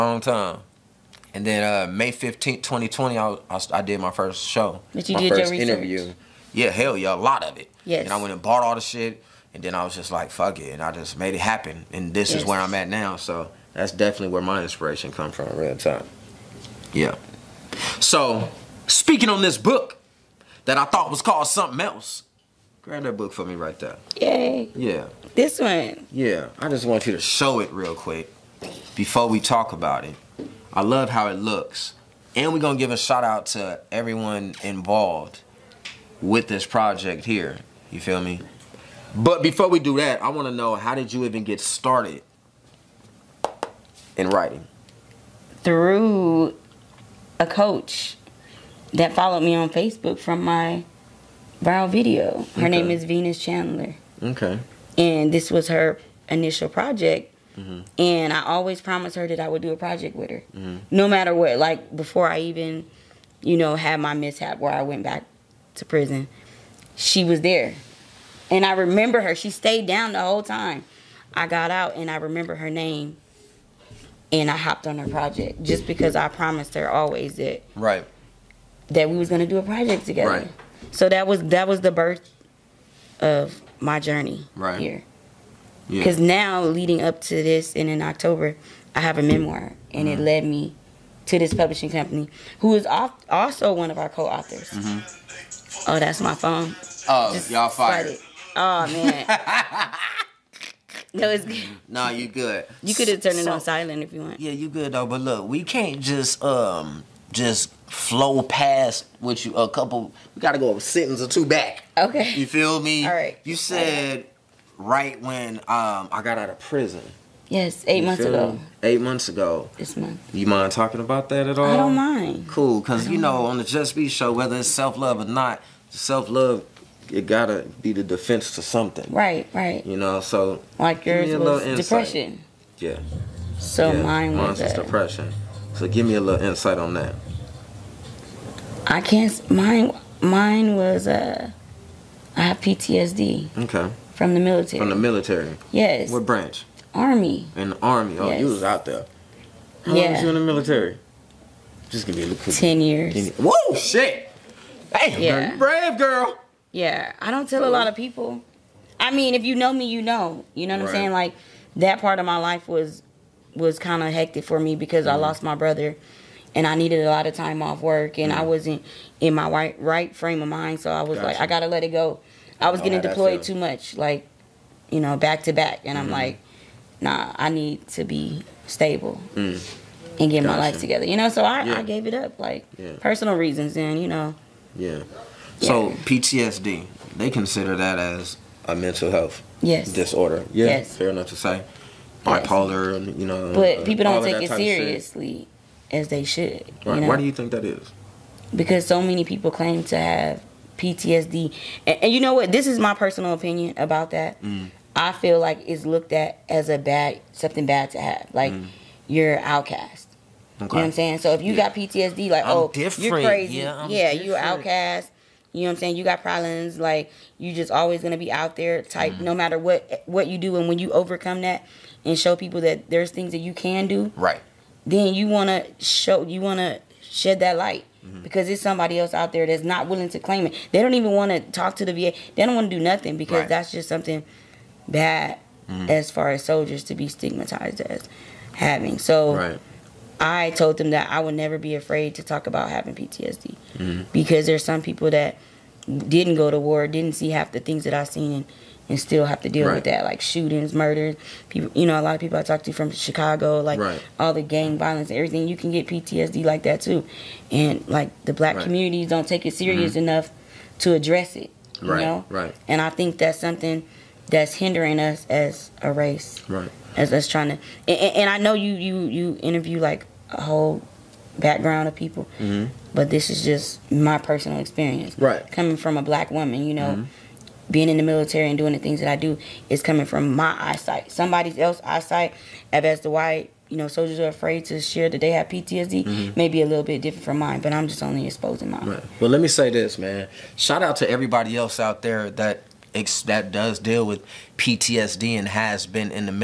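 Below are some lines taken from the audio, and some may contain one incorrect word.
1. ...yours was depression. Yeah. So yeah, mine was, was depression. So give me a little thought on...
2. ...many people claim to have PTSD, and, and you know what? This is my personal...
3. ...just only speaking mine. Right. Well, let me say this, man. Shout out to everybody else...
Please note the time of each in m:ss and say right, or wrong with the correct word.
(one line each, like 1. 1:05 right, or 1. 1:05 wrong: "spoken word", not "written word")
1. 2:11 wrong: "insight", not "thought"
2. 3:19 right
3. 4:47 wrong: "exposing", not "speaking".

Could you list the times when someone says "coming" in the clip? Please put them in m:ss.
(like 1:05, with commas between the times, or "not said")
4:35, 4:39.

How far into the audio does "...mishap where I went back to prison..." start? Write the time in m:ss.
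1:04.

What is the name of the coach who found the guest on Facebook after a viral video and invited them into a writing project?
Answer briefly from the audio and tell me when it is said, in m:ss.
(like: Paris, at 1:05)
Venus Chandler, at 0:53.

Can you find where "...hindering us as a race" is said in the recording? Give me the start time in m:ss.
4:24.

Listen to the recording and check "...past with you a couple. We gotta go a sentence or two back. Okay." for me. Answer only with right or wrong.
right.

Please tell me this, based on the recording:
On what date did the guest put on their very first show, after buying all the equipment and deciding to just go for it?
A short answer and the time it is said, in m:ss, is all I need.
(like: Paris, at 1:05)
May 15th, 2020, at 0:01.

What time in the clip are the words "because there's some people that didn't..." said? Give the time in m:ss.
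4:04.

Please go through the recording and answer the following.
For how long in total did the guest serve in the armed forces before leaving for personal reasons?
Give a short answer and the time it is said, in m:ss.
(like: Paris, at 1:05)
10 years, at 2:32.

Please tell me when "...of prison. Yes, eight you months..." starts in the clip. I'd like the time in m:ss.
1:56.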